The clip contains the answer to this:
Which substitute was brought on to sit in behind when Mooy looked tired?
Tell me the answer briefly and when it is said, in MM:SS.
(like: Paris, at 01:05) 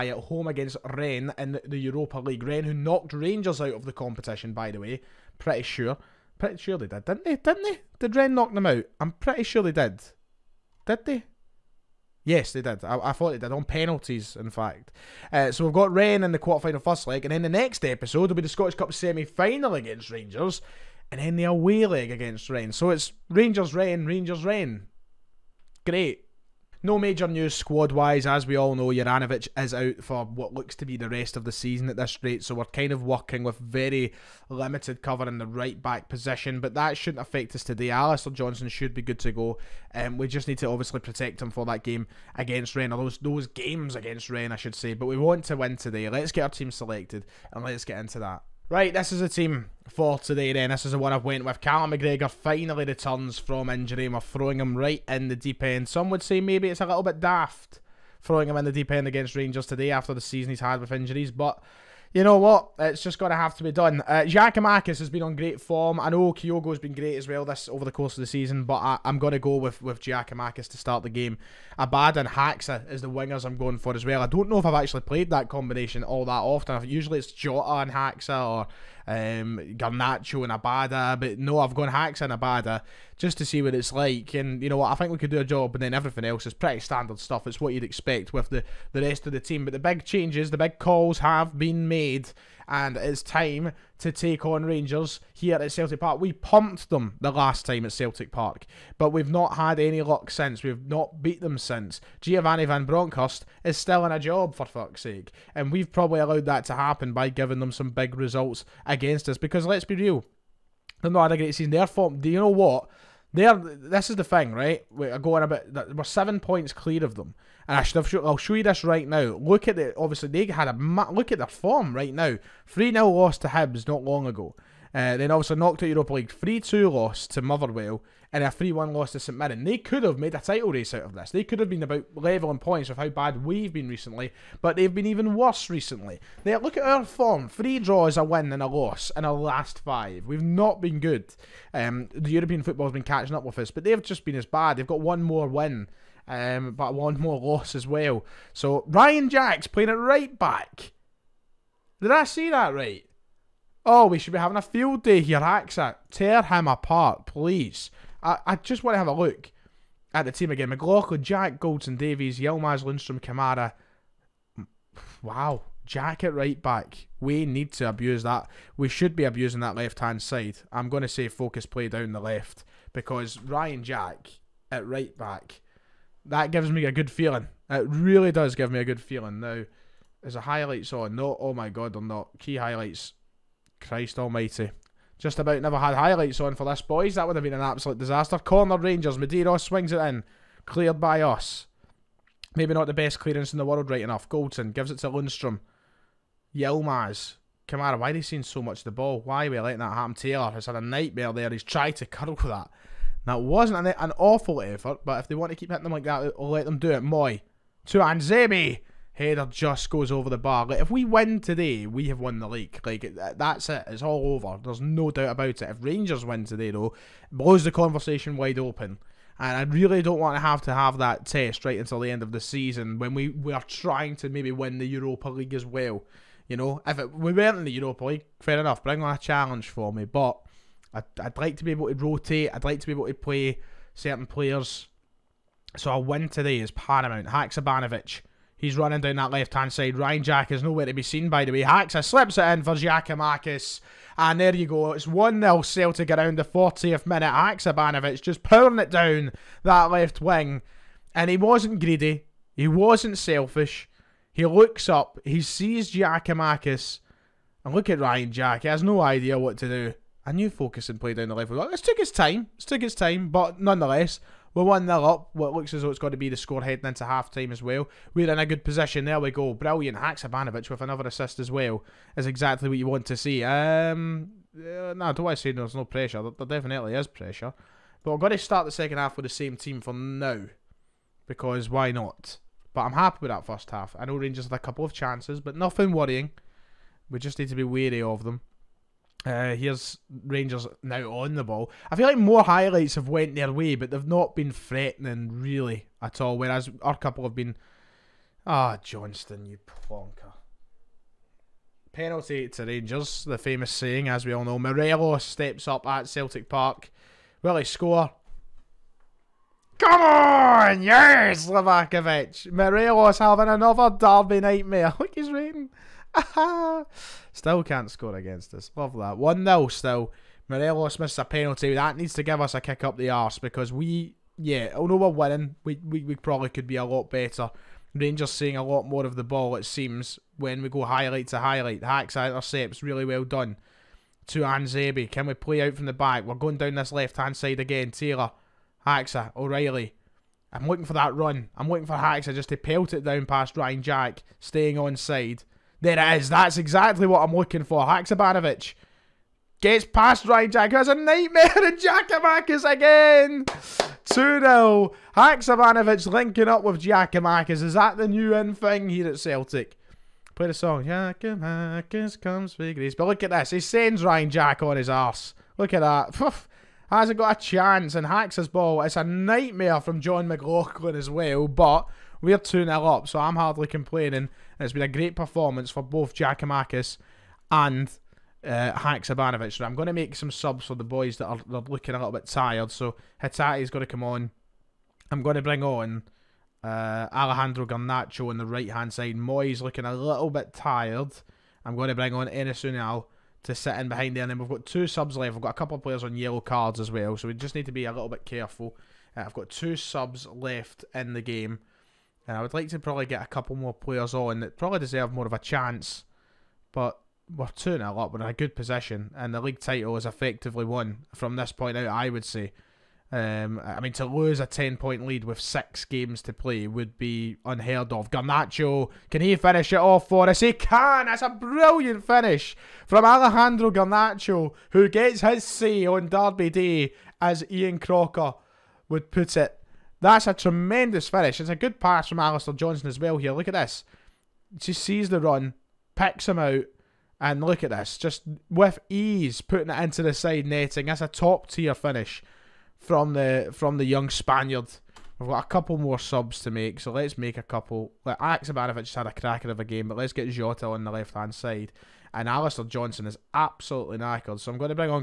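Enes Unal, at 06:32.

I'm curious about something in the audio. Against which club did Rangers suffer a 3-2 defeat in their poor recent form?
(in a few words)
Motherwell.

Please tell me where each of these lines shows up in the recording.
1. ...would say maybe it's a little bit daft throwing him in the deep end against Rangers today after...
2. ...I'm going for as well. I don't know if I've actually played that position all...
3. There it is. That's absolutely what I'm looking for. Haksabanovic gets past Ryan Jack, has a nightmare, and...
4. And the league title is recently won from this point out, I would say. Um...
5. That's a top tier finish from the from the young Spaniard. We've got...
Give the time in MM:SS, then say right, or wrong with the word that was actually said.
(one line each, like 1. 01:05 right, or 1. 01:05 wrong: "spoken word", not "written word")
1. 00:56 right
2. 01:13 wrong: "combination", not "position"
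3. 05:45 wrong: "exactly", not "absolutely"
4. 06:49 wrong: "effectively", not "recently"
5. 07:20 right.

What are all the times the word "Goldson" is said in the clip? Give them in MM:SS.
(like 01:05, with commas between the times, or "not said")
02:41, 03:14.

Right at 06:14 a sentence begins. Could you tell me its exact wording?
And it's been a great performance for both Jack and uh, Haksabanovic.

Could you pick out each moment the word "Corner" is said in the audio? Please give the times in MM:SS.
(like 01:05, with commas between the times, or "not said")
03:08.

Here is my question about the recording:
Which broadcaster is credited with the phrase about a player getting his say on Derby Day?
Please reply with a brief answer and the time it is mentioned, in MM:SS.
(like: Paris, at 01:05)
Ian Crocker, at 07:07.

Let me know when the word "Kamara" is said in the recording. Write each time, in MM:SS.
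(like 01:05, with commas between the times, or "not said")
02:43, 03:17.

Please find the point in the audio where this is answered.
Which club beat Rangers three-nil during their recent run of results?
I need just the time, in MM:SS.
02:02.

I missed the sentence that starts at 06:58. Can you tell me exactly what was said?
Garnacho, can he finish it off for us?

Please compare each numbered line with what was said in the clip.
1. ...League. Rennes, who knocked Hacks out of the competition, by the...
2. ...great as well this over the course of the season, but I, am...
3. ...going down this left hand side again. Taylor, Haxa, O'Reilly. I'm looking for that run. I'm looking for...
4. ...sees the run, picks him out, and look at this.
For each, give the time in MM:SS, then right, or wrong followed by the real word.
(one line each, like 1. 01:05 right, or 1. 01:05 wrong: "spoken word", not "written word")
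1. 00:02 wrong: "Rangers", not "Hacks"
2. 01:06 right
3. 05:36 right
4. 07:14 right.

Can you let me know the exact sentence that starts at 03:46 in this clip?
You know, if it, we weren't in the Europa League, fair enough, bring on a challenge for me.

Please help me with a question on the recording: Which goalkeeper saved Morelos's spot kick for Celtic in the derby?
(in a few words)
Livakovic.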